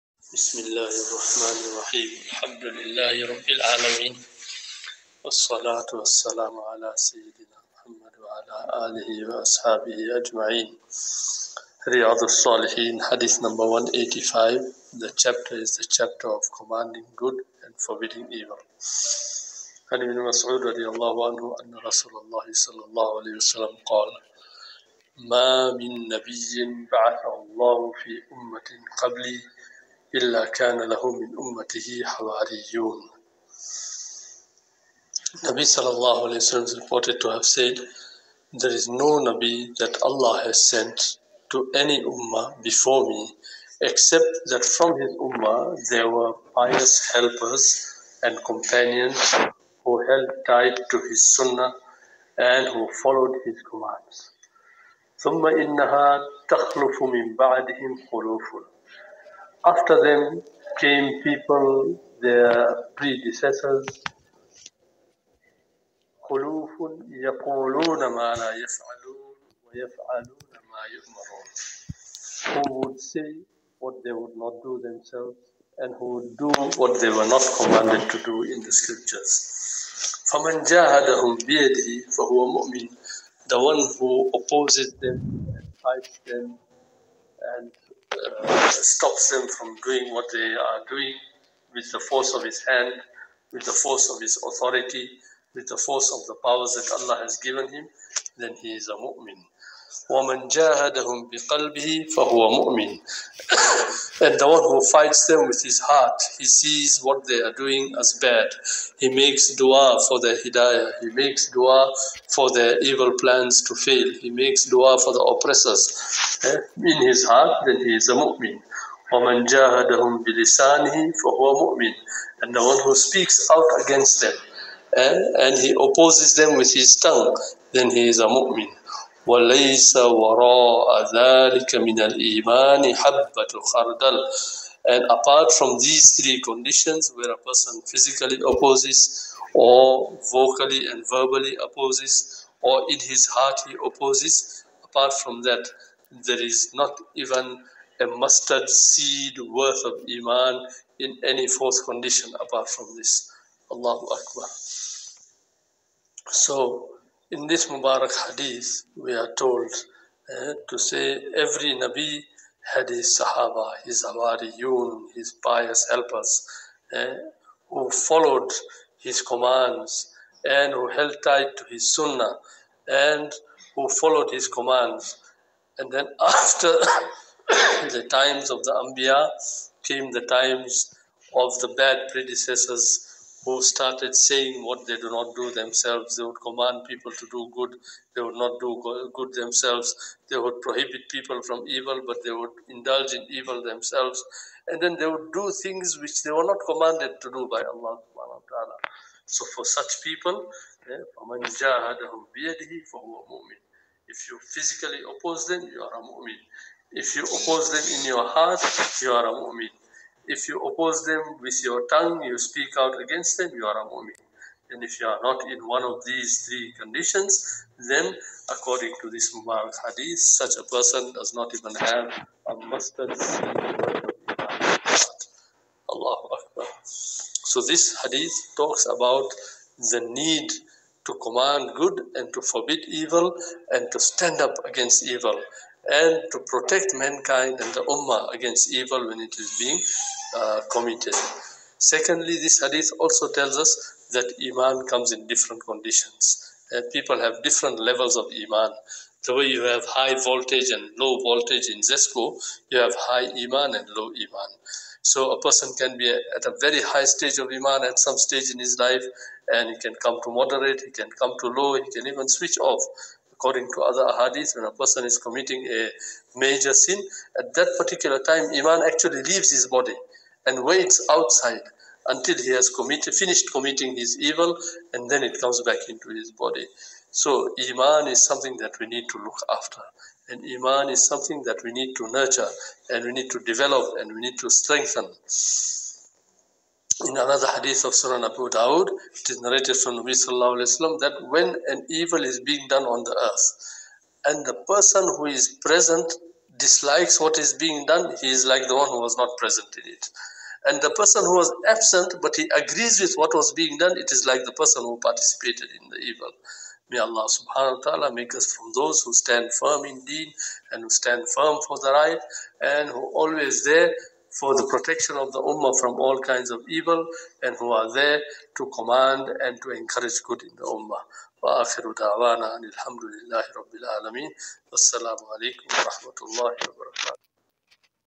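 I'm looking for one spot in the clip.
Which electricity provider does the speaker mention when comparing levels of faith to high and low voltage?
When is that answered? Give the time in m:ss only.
4:11.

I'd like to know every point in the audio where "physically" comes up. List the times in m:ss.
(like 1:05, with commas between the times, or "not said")
2:17, 3:24.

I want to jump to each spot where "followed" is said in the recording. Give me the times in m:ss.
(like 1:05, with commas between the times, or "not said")
0:53, 2:47, 2:53.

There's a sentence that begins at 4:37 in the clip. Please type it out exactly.
So, Iman is something that we need to look after.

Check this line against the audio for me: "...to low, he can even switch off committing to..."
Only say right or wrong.
wrong.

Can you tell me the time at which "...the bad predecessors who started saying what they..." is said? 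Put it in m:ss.
3:01.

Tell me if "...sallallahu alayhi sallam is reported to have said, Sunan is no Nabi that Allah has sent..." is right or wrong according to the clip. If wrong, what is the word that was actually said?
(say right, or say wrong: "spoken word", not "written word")
wrong: "There", not "Sunan".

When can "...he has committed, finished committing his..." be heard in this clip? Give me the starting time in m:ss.
4:32.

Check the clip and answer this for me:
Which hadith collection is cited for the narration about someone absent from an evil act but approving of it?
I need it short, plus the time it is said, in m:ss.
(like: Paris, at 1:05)
Sunan Abu Dawud, at 4:47.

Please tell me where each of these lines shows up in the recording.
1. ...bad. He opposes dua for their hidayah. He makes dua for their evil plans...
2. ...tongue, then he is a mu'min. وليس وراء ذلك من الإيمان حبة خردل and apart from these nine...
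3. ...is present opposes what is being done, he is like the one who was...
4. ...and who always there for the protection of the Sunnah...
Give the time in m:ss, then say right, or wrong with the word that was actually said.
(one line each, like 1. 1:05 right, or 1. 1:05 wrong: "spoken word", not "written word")
1. 1:48 wrong: "makes", not "opposes"
2. 2:06 wrong: "three", not "nine"
3. 4:55 wrong: "dislikes", not "opposes"
4. 5:12 wrong: "Ummah", not "Sunnah".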